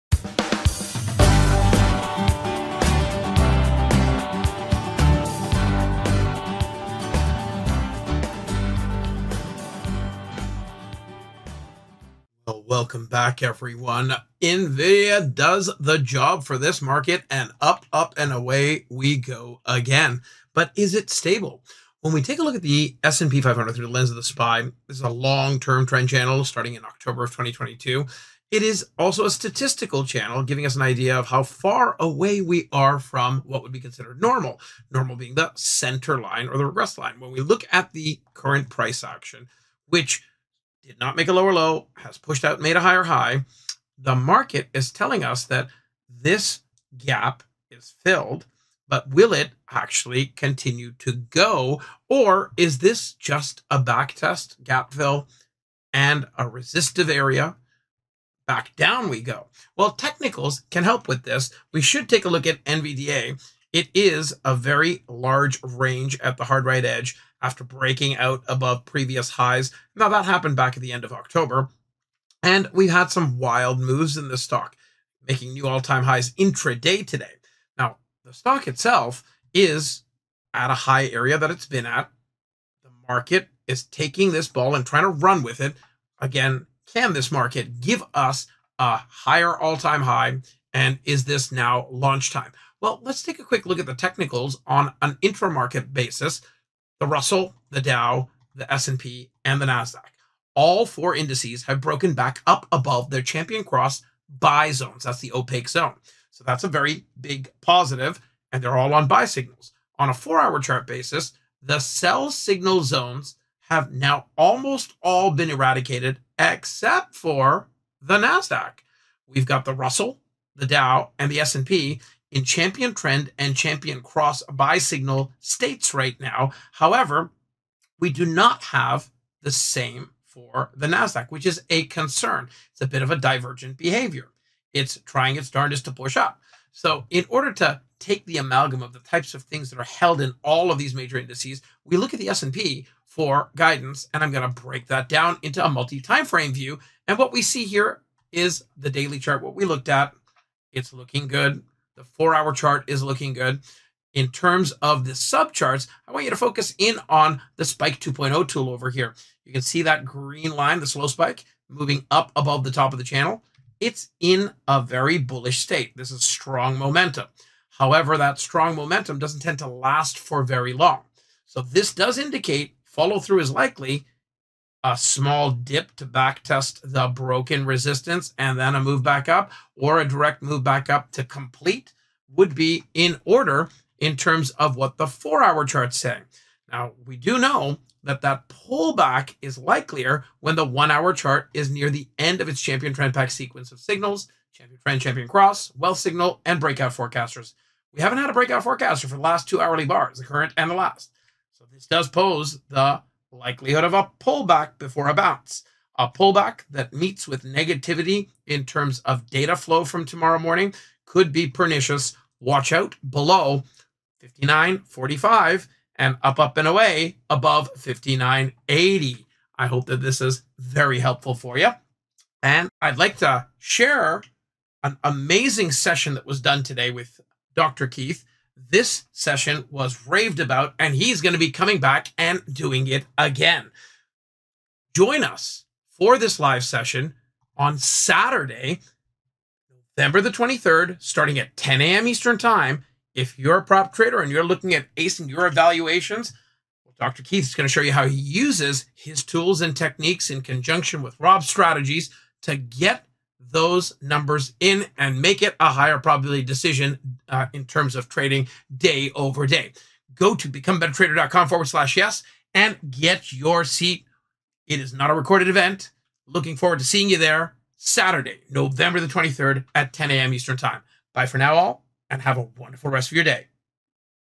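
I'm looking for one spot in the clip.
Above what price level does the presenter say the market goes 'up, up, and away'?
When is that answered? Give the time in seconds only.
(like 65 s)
217 s.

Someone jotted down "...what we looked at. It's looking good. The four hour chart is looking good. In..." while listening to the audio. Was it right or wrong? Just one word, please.
right.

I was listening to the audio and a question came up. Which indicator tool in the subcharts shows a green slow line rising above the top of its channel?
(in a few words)
Spike 2.0.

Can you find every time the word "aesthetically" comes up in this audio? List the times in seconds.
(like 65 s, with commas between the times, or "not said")
not said.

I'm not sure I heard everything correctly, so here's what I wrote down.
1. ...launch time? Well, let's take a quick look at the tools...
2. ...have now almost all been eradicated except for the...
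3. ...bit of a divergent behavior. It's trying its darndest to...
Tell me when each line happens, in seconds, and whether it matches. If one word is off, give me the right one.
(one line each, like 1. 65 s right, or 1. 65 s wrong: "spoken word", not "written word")
1. 91 s wrong: "technicals", not "tools"
2. 113 s right
3. 132 s right.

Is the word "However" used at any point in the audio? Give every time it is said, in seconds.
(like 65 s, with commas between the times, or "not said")
126 s, 167 s.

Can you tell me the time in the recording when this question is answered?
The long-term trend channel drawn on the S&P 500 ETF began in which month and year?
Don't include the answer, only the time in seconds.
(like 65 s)
26 s.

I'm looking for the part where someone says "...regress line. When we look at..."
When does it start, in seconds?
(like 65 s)
36 s.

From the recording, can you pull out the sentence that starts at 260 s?
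Go to becomebettertrader.com forward slash yes and get your seat.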